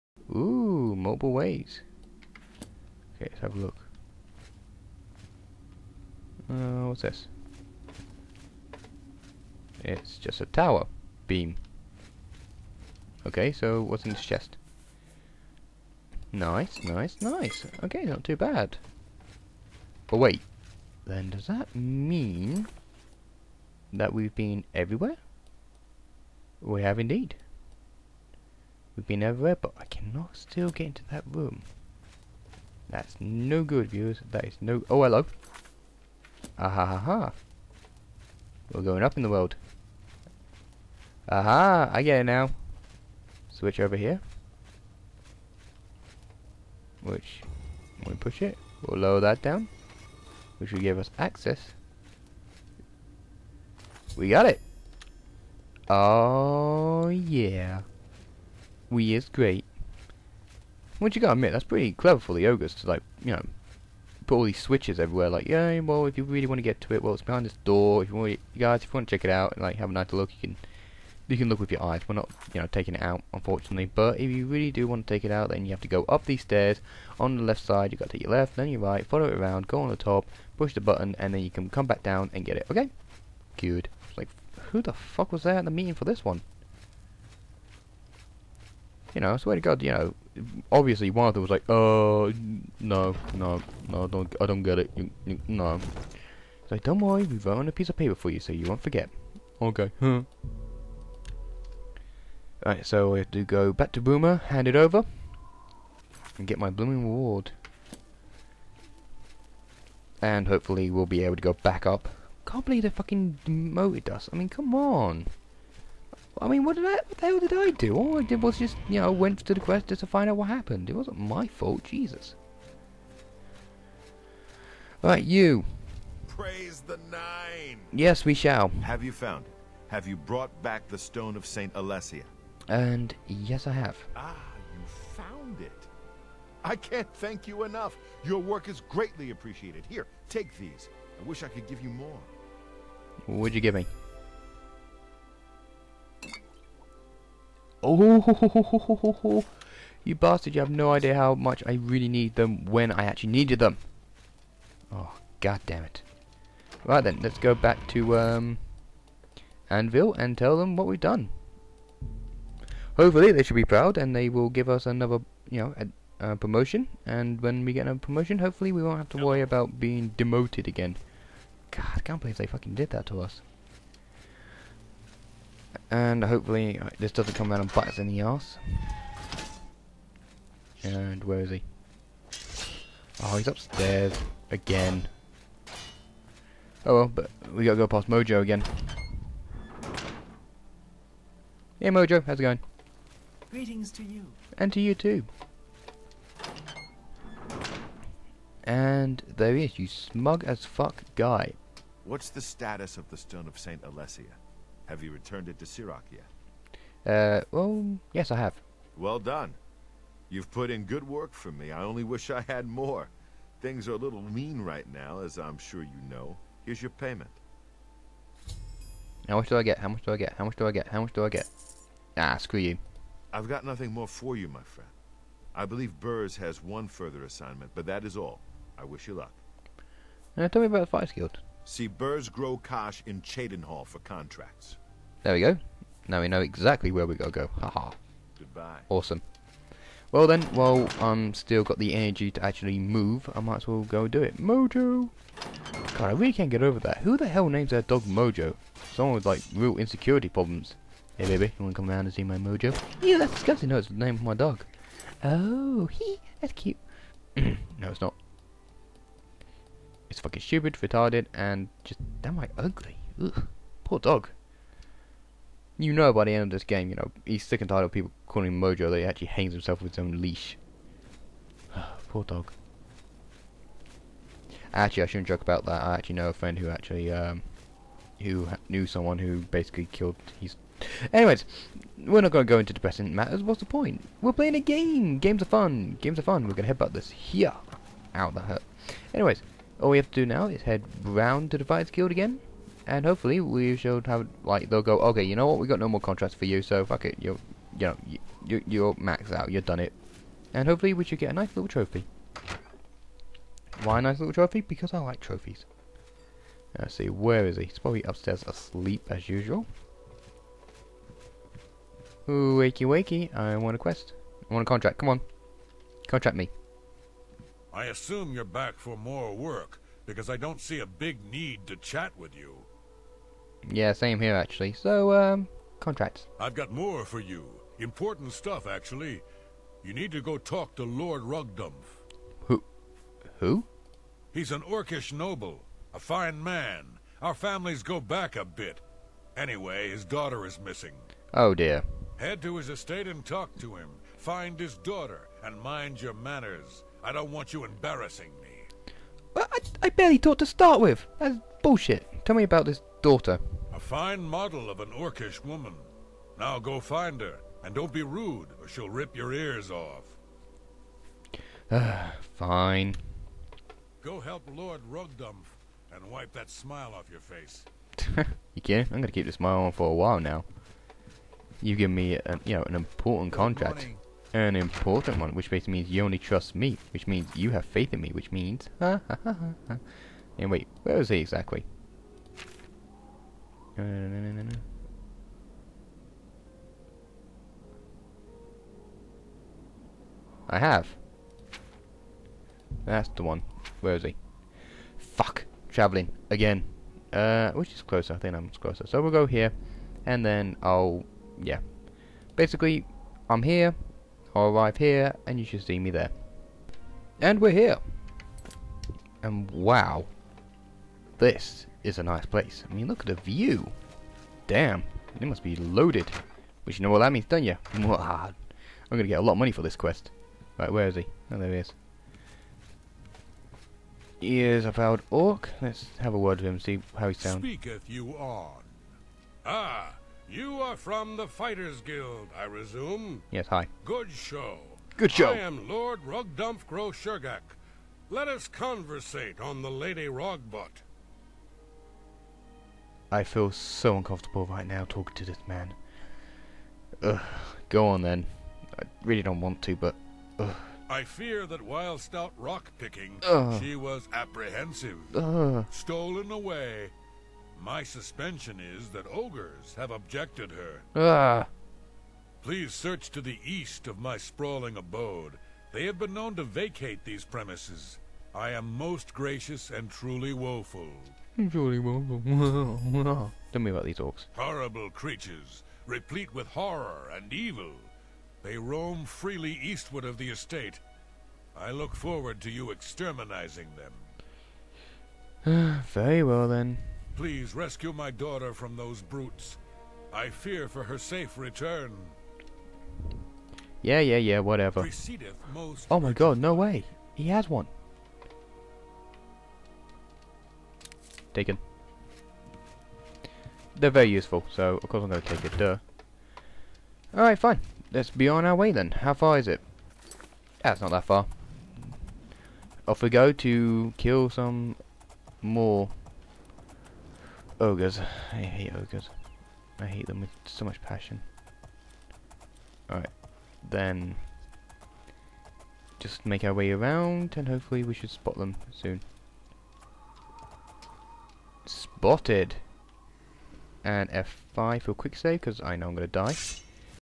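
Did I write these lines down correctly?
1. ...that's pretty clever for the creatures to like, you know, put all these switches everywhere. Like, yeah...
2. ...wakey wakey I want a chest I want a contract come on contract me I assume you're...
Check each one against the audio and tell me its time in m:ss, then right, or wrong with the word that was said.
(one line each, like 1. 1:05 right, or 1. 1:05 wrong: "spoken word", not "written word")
1. 1:01 wrong: "ogres", not "creatures"
2. 5:12 wrong: "quest", not "chest".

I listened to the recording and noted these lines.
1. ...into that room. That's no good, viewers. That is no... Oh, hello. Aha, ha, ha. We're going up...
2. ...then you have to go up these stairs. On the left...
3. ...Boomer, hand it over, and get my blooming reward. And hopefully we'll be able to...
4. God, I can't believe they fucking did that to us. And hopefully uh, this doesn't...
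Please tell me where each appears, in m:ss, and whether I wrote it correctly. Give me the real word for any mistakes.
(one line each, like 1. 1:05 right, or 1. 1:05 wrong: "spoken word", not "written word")
1. 0:30 right
2. 1:15 right
3. 1:44 right
4. 2:51 right.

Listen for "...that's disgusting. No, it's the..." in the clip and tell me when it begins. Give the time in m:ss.
4:13.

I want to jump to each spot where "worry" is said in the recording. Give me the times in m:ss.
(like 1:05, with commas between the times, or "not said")
1:36, 2:49.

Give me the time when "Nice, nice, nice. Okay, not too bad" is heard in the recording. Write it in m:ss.
0:16.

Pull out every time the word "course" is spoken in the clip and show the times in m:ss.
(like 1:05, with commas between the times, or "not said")
8:24.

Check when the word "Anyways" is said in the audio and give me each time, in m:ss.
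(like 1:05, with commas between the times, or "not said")
4:41, 4:49, 5:39.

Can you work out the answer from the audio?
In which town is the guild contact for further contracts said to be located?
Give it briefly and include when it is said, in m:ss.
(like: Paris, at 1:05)
Cheydinhal, at 3:53.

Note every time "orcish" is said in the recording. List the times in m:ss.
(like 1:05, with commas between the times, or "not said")
5:34, 5:54.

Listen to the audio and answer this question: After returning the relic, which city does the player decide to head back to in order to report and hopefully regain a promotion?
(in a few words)
Anvil.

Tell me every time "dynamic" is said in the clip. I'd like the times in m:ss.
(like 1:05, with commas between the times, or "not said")
not said.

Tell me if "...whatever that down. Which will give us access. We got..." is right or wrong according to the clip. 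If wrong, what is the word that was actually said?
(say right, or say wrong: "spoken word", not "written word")
wrong: "lower", not "whatever".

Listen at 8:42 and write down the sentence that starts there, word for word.
Alright, then just make our way around and hopefully we should spot them soon spotted.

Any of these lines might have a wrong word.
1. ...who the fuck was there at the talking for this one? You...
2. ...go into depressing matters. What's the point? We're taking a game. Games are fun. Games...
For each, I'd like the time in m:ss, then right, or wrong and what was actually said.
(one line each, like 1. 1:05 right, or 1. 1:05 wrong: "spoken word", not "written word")
1. 1:24 wrong: "meeting", not "talking"
2. 4:42 wrong: "playing", not "taking".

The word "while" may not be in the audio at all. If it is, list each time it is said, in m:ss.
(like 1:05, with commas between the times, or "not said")
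4:00, 6:09, 7:31.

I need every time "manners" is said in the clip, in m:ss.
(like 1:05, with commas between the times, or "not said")
5:46.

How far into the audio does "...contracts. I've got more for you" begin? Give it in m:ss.
5:25.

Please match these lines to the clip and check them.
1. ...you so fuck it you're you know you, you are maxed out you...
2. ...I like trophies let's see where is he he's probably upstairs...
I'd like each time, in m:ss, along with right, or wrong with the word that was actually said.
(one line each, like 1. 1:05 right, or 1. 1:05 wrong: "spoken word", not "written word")
1. 4:56 right
2. 5:04 right.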